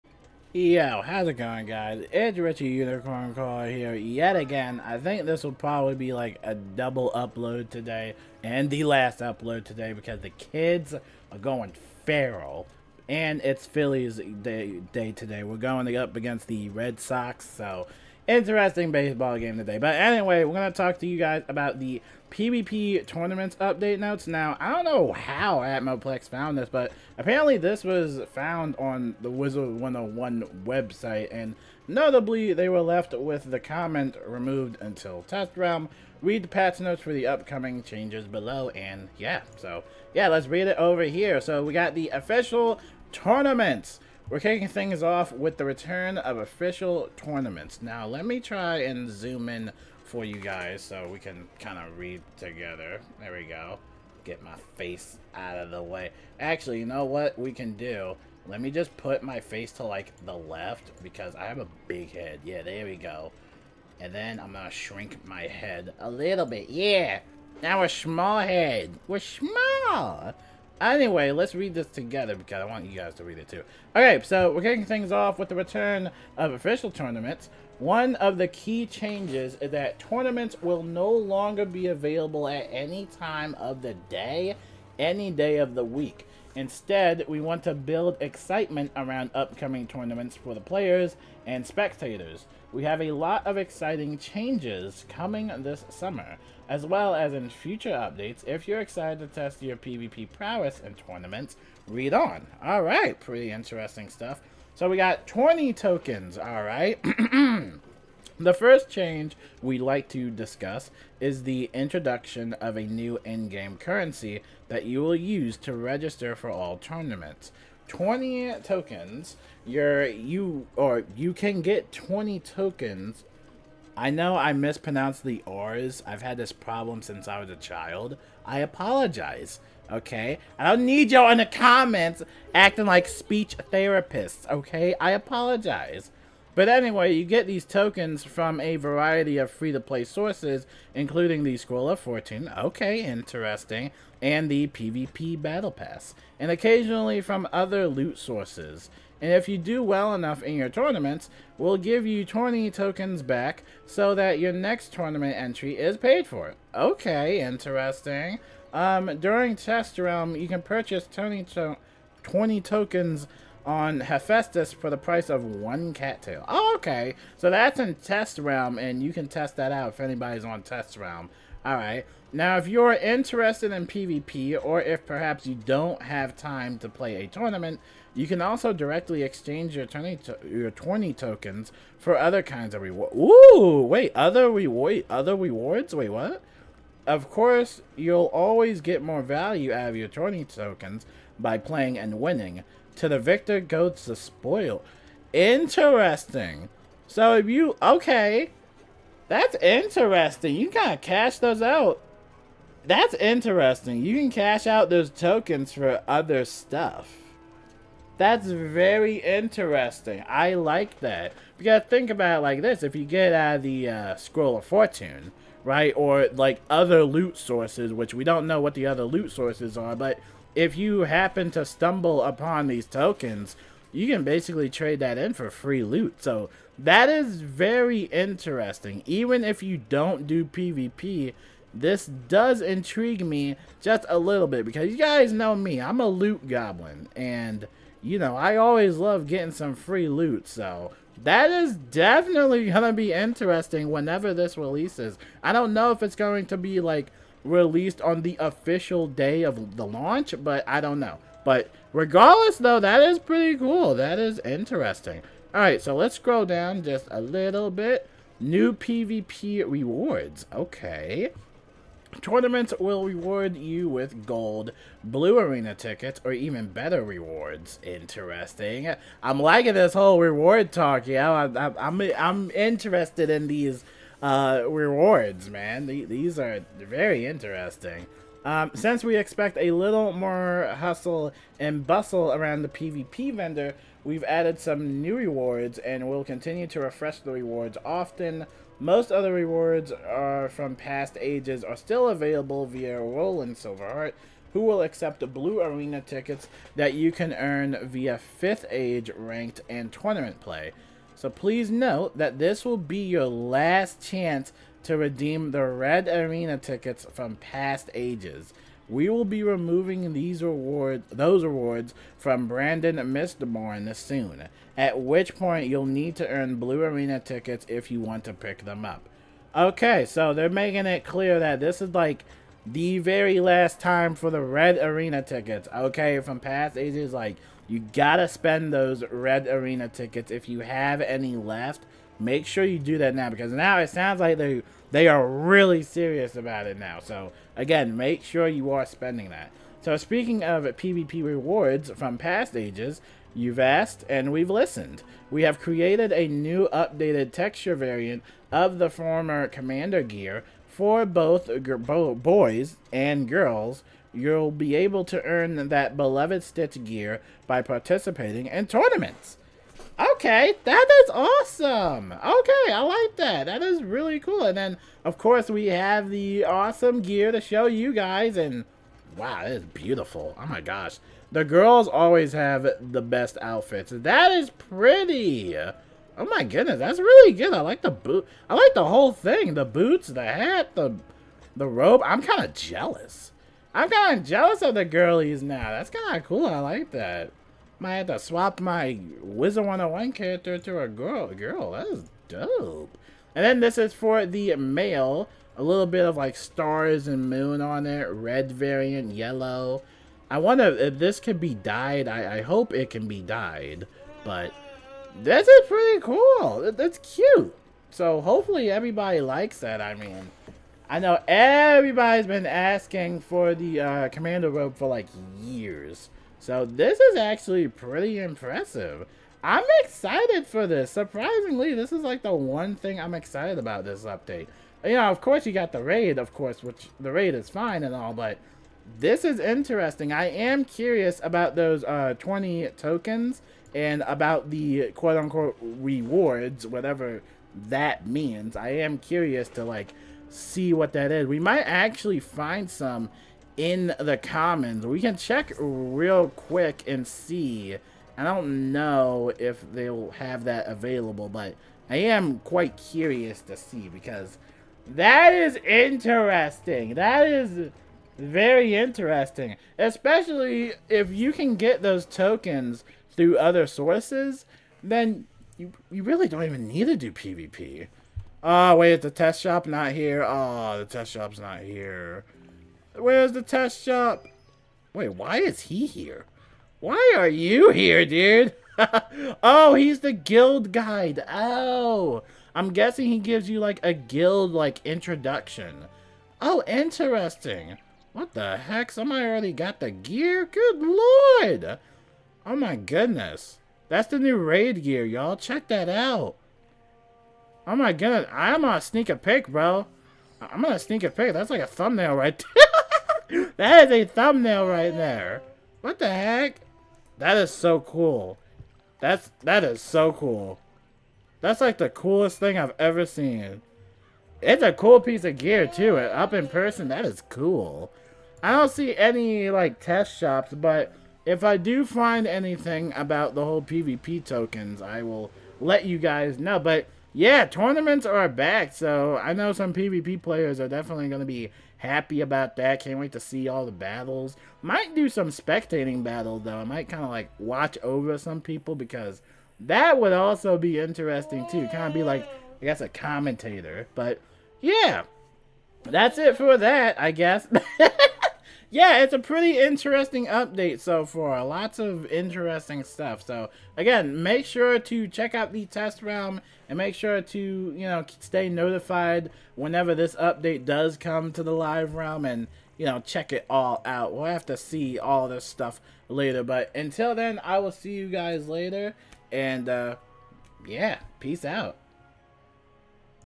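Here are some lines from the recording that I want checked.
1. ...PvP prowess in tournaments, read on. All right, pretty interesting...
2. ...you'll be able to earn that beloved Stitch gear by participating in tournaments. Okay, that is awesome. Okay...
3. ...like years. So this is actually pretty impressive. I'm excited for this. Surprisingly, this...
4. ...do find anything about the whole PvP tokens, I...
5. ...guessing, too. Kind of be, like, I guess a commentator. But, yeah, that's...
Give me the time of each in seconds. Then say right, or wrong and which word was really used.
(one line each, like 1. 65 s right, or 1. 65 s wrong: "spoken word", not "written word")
1. 99 s right
2. 354 s right
3. 414 s right
4. 521 s right
5. 540 s wrong: "interesting", not "guessing".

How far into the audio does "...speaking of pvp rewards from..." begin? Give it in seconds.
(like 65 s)
339 s.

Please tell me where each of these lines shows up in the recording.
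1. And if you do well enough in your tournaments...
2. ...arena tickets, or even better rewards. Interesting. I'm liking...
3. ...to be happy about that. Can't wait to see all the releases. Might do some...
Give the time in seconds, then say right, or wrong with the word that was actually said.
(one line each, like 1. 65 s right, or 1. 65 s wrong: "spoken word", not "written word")
1. 149 s right
2. 265 s right
3. 531 s wrong: "battles", not "releases".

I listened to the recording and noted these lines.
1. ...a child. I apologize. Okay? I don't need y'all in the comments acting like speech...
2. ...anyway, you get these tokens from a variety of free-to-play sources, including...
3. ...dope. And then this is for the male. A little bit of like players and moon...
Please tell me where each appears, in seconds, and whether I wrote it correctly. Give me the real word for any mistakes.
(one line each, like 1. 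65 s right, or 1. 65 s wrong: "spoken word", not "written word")
1. 127 s right
2. 136 s right
3. 392 s wrong: "stars", not "players".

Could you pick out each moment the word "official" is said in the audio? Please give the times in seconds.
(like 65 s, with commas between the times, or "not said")
42 s, 46 s, 76 s, 248 s.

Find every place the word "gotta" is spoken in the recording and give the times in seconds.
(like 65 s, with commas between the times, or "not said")
211 s, 327 s.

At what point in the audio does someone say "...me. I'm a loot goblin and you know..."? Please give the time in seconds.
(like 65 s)
235 s.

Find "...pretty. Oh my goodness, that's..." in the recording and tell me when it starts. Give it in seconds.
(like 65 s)
374 s.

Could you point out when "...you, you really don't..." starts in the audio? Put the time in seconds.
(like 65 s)
465 s.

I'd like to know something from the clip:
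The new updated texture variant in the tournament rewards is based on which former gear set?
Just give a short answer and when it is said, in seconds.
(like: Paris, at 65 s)
Commander gear, at 349 s.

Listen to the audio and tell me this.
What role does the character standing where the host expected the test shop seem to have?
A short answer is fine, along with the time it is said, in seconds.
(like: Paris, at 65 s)
guild guide, at 480 s.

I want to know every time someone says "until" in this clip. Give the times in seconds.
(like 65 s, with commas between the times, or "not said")
34 s, 566 s.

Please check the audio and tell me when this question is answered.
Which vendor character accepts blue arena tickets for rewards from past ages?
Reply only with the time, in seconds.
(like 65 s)
292 s.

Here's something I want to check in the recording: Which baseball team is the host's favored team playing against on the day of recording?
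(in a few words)
Red Sox.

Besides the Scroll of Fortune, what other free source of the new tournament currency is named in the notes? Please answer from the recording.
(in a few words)
PvP Battle Pass.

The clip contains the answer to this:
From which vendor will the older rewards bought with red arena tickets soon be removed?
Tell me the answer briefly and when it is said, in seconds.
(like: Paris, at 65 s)
Brandon Mistborn, at 312 s.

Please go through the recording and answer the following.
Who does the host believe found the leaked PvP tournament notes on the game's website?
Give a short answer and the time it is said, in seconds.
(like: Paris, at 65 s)
Atmoplex, at 25 s.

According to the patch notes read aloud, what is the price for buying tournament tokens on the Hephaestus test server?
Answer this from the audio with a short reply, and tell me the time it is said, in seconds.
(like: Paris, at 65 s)
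one cattail, at 165 s.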